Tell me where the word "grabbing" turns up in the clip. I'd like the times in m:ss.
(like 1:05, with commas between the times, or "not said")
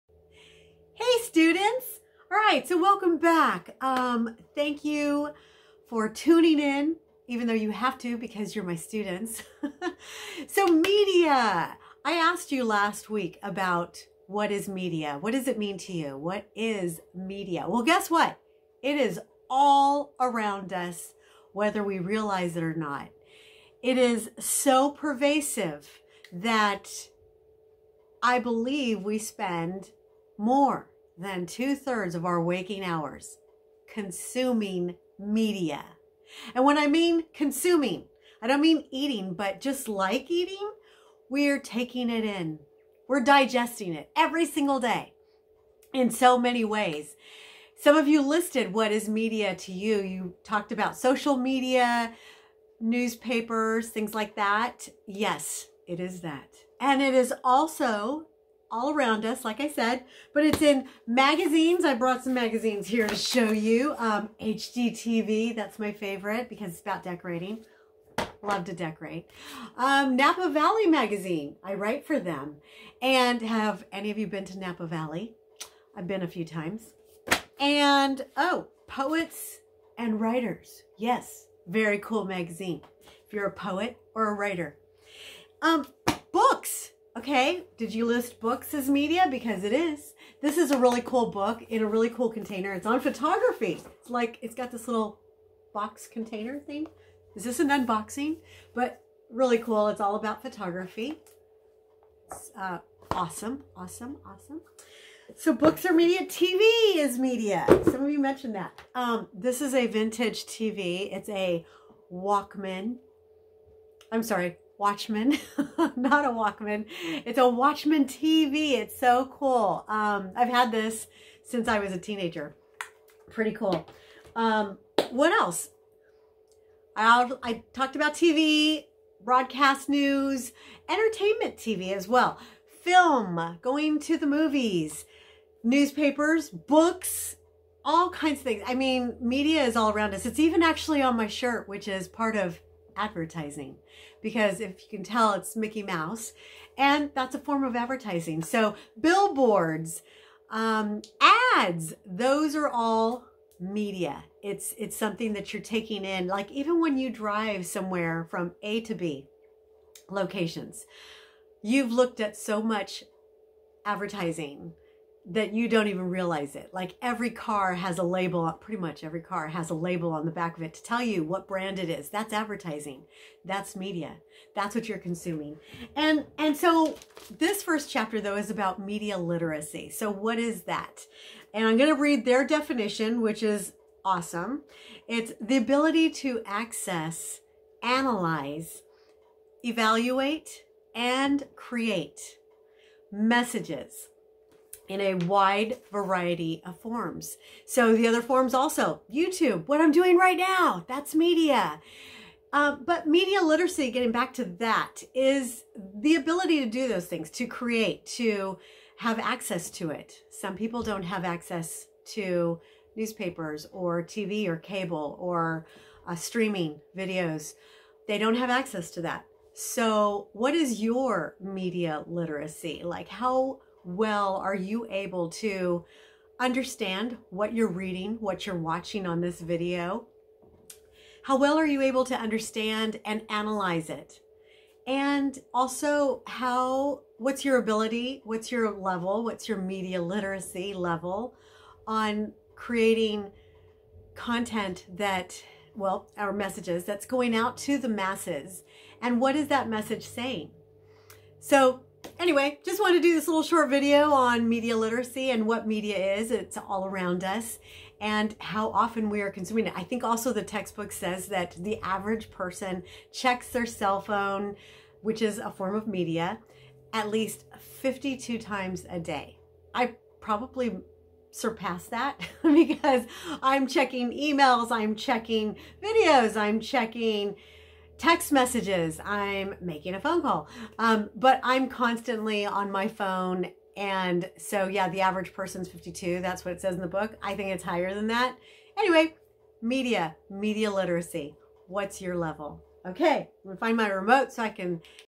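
not said.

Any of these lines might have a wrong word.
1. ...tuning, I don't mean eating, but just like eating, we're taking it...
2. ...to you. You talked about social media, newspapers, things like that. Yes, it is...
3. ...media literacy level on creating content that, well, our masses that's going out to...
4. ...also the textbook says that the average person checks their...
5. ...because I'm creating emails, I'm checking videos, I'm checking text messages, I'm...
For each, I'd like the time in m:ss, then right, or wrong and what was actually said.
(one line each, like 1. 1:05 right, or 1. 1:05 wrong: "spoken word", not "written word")
1. 0:37 wrong: "consuming", not "tuning"
2. 0:49 right
3. 3:59 wrong: "messages", not "masses"
4. 4:20 right
5. 4:32 wrong: "checking", not "creating".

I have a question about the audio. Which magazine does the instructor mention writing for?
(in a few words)
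Napa Valley Magazine.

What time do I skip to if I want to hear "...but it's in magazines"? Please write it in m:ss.
1:00.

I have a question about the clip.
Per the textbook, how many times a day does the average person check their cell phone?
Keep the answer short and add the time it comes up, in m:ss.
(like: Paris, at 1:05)
52, at 4:27.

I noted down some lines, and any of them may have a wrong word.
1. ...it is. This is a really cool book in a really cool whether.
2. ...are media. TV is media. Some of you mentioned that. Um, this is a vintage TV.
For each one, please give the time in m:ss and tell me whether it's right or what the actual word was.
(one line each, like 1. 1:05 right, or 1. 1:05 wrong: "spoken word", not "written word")
1. 1:29 wrong: "container", not "whether"
2. 1:45 right.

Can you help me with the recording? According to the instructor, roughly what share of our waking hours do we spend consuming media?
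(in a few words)
two thirds.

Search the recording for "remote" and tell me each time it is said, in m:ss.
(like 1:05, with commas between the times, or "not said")
4:53.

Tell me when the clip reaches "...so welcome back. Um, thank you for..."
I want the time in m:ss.
0:02.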